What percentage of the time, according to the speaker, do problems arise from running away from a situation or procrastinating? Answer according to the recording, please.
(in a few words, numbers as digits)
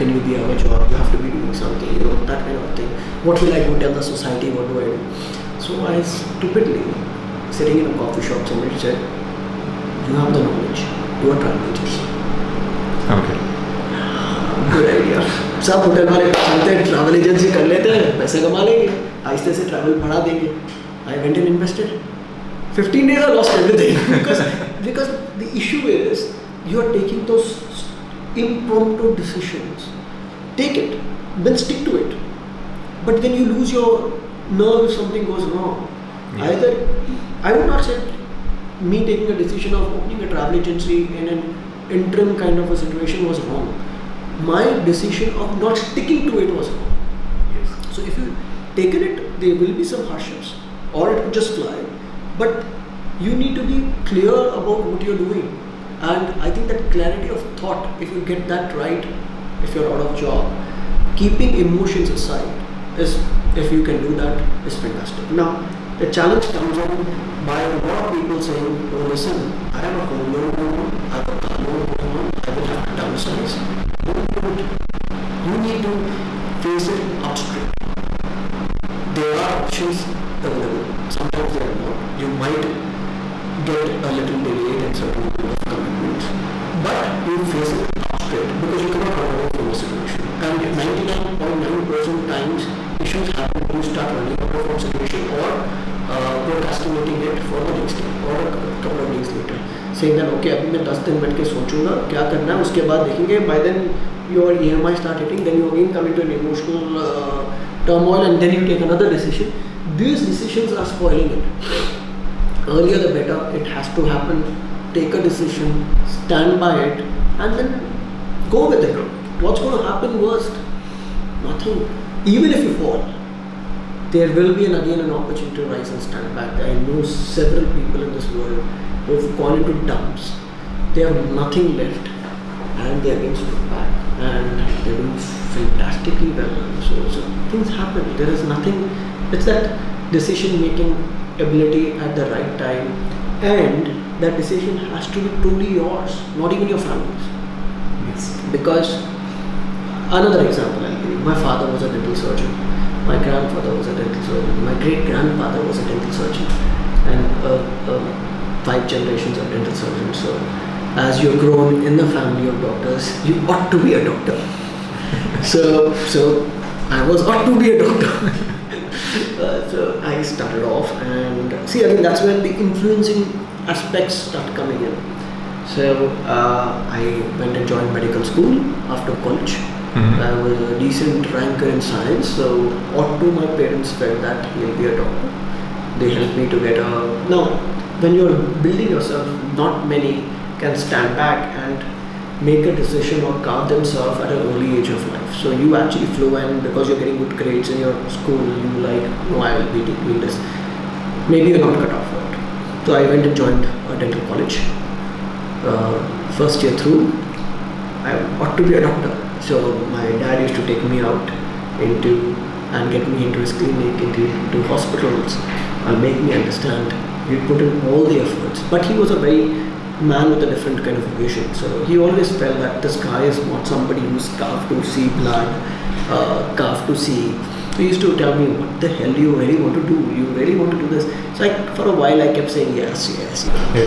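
99.9%.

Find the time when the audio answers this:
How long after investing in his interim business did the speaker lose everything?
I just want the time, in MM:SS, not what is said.
00:22.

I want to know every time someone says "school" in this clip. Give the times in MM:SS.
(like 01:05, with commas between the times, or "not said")
02:58, 03:18.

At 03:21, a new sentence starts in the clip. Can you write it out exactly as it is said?
Maybe you're not cut off for it.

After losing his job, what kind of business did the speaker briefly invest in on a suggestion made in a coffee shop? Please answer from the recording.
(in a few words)
travel agency.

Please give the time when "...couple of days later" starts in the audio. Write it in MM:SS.
01:38.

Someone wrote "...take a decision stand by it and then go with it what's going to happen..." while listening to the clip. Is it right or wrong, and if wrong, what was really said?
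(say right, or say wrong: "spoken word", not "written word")
right.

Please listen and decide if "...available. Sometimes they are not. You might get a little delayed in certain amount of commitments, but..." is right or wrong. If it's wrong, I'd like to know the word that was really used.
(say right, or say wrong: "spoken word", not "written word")
right.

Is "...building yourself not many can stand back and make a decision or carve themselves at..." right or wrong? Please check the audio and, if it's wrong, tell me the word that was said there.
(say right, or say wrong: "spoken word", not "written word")
right.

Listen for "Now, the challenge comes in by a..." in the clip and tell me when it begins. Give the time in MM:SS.
01:05.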